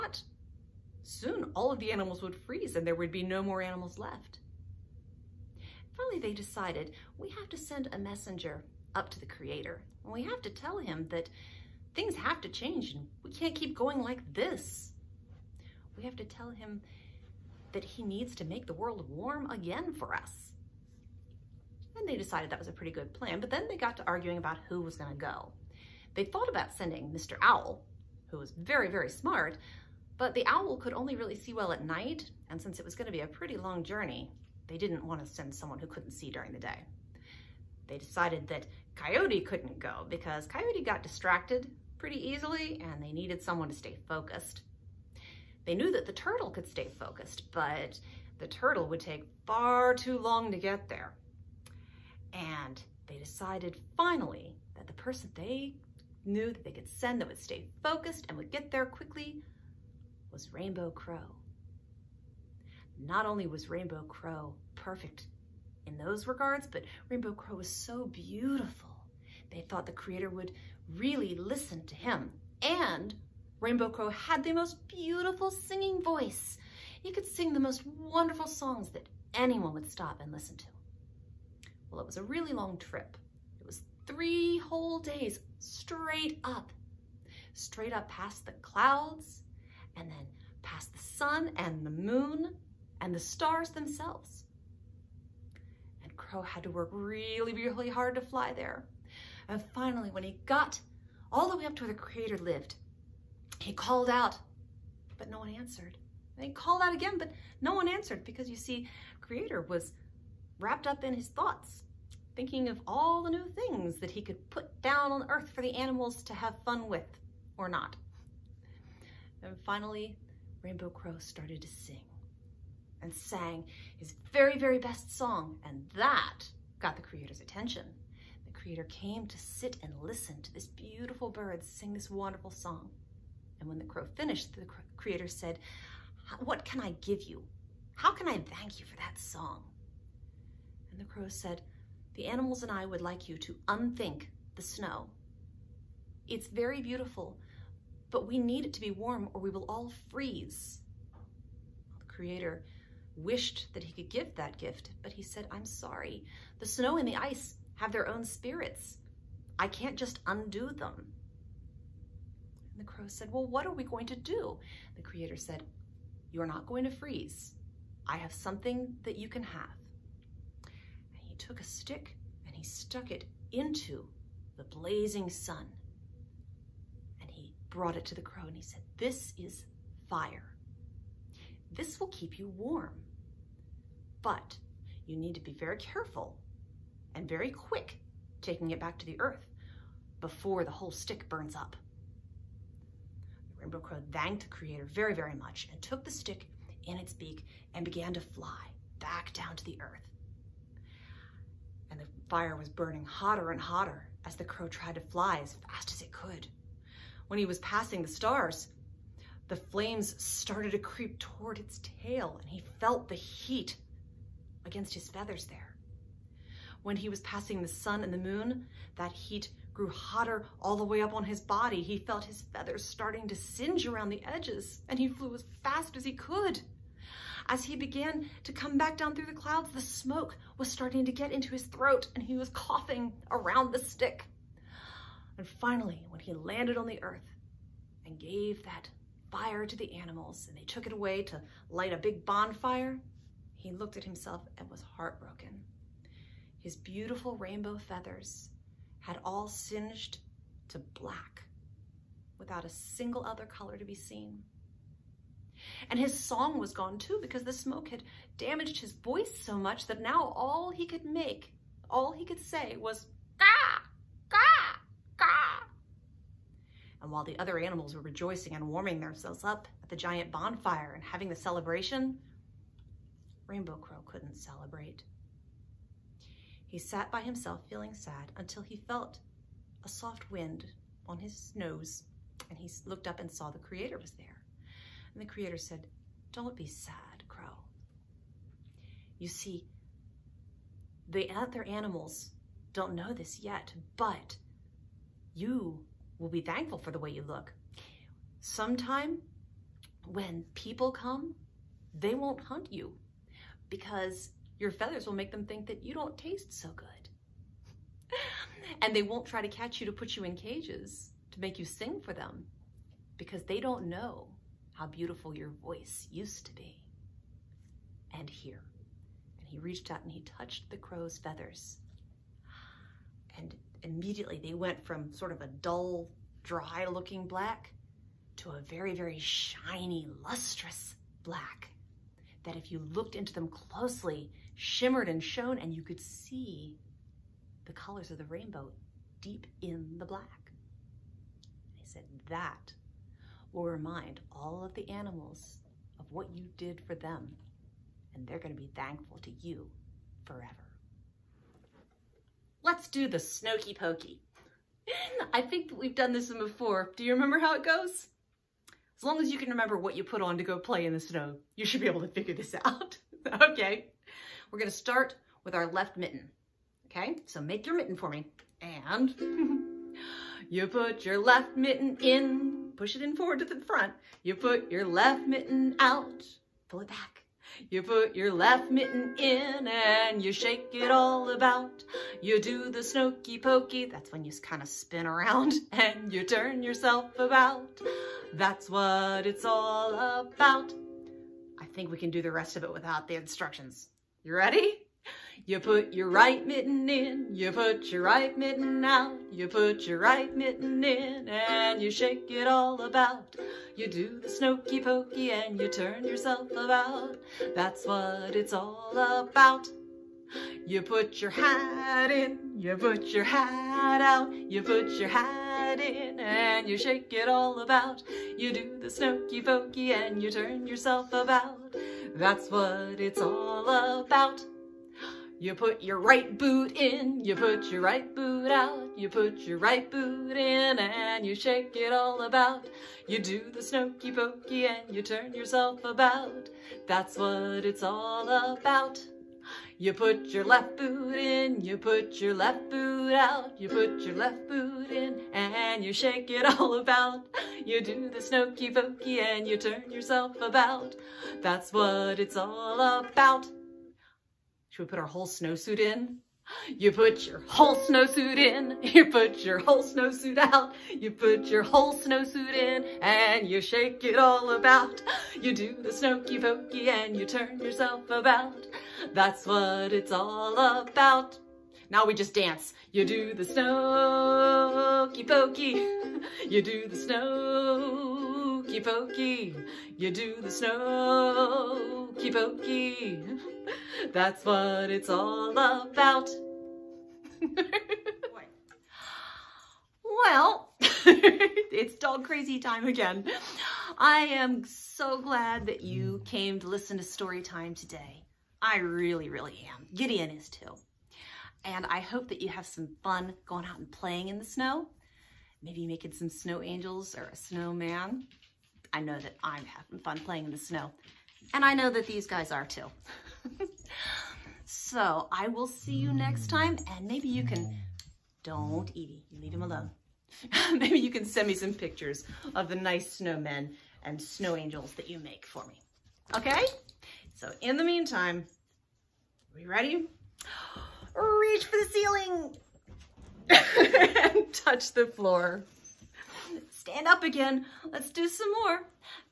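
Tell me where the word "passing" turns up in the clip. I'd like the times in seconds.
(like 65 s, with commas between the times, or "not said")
207 s, 217 s.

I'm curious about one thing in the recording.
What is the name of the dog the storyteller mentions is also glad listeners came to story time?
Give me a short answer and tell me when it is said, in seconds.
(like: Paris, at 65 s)
Gideon, at 499 s.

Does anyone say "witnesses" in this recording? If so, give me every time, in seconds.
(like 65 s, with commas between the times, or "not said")
not said.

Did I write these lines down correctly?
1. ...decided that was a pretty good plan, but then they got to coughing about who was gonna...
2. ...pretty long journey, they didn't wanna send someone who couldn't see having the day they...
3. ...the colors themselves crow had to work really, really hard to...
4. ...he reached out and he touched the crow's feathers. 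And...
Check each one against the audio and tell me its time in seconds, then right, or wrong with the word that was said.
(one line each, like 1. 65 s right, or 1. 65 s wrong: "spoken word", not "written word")
1. 22 s wrong: "arguing", not "coughing"
2. 33 s wrong: "during", not "having"
3. 93 s wrong: "stars", not "colors"
4. 319 s right.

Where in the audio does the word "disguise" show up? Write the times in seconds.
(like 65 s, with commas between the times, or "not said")
not said.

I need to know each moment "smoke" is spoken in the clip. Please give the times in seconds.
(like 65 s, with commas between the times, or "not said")
229 s, 257 s.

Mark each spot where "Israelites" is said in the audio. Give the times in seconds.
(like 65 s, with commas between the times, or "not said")
not said.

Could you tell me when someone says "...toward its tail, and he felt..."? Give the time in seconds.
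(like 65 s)
211 s.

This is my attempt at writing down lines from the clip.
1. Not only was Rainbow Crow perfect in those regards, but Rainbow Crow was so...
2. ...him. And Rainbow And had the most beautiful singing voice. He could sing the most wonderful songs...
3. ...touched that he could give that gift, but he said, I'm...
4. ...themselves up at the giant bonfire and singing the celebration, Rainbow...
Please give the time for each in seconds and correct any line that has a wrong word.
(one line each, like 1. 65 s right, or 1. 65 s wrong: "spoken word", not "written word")
1. 63 s right
2. 71 s wrong: "Crow", not "And"
3. 153 s wrong: "wished", not "touched"
4. 269 s wrong: "having", not "singing".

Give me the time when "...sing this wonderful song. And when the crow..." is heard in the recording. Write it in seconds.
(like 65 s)
131 s.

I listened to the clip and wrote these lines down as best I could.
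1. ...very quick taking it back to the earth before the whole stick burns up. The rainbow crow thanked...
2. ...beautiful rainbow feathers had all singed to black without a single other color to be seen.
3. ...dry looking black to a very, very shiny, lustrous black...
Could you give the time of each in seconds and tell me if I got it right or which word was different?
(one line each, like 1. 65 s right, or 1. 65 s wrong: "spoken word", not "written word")
1. 187 s right
2. 246 s right
3. 326 s right.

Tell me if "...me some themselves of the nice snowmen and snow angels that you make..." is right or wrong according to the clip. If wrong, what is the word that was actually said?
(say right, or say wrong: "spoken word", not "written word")
wrong: "pictures", not "themselves".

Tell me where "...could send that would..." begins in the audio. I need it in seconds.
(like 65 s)
56 s.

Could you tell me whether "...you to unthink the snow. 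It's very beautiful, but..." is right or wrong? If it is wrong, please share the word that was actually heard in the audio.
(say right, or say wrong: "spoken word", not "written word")
right.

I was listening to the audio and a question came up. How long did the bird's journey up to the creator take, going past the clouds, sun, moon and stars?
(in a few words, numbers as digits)
3 days.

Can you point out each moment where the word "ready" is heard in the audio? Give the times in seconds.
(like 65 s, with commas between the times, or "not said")
394 s, 529 s.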